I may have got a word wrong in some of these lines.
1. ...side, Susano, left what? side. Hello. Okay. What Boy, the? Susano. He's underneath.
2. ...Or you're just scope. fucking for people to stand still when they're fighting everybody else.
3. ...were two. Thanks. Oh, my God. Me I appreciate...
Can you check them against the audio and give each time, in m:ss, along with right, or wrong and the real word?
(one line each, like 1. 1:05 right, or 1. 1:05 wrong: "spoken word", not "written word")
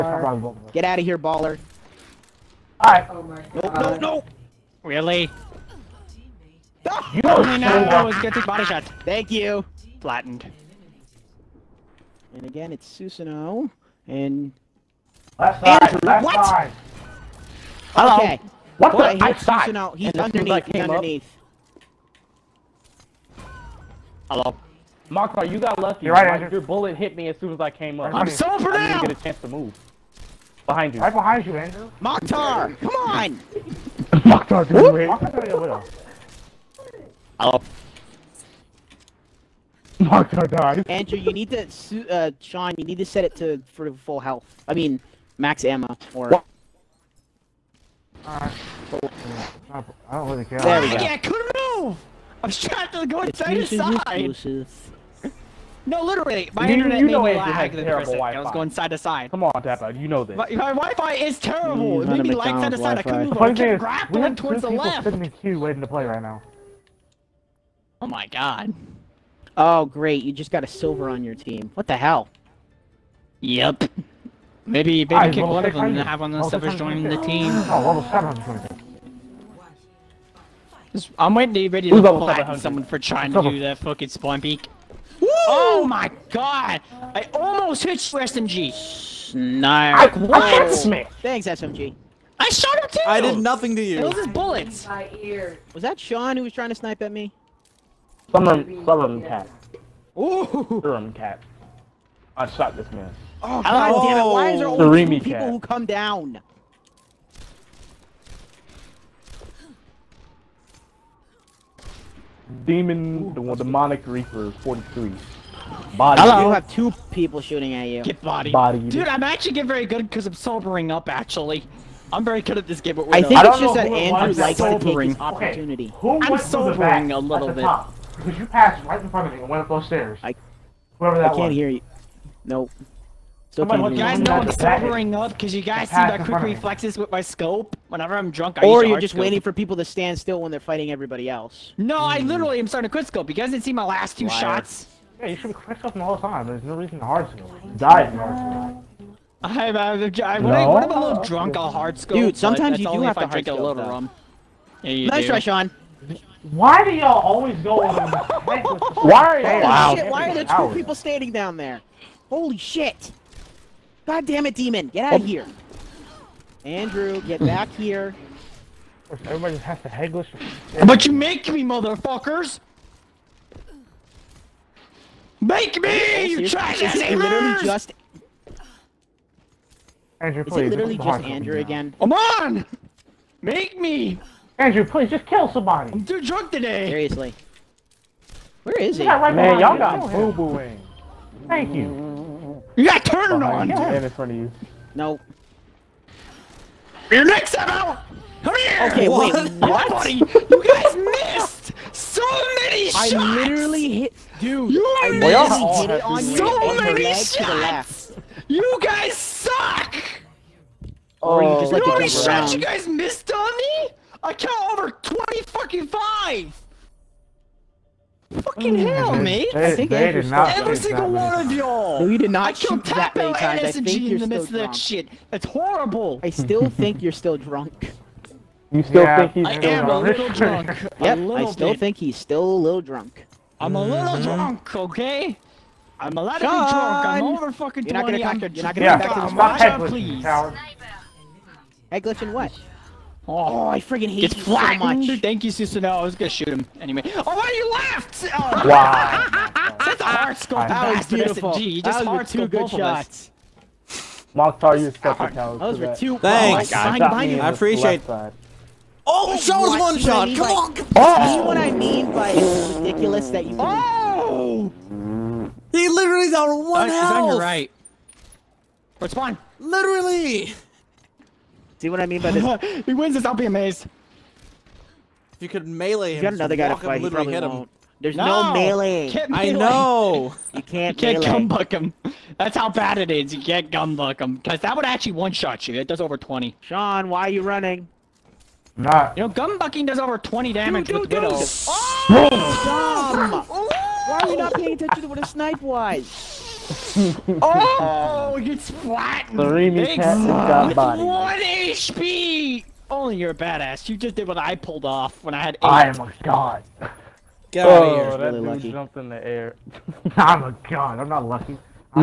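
1. 0:15 wrong: "Andrew", not "Susano"
2. 2:18 wrong: "waiting", not "fucking"
3. 4:15 right.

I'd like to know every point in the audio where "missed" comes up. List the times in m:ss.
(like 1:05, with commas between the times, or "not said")
3:20, 3:32.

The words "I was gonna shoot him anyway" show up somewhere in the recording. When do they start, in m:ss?
4:05.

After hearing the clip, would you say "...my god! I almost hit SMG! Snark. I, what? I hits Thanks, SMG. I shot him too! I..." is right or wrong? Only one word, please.
right.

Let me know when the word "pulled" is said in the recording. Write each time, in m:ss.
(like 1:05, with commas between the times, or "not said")
5:04.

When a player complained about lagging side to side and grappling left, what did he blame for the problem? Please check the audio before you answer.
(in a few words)
Wi-Fi.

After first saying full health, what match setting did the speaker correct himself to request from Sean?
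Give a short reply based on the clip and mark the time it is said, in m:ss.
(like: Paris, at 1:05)
max ammo, at 0:45.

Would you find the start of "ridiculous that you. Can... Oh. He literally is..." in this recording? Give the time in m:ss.
4:22.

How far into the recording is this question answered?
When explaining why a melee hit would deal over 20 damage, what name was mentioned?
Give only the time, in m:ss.
4:51.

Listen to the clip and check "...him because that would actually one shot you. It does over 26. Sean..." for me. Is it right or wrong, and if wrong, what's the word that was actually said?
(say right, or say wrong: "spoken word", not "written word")
wrong: "20", not "26".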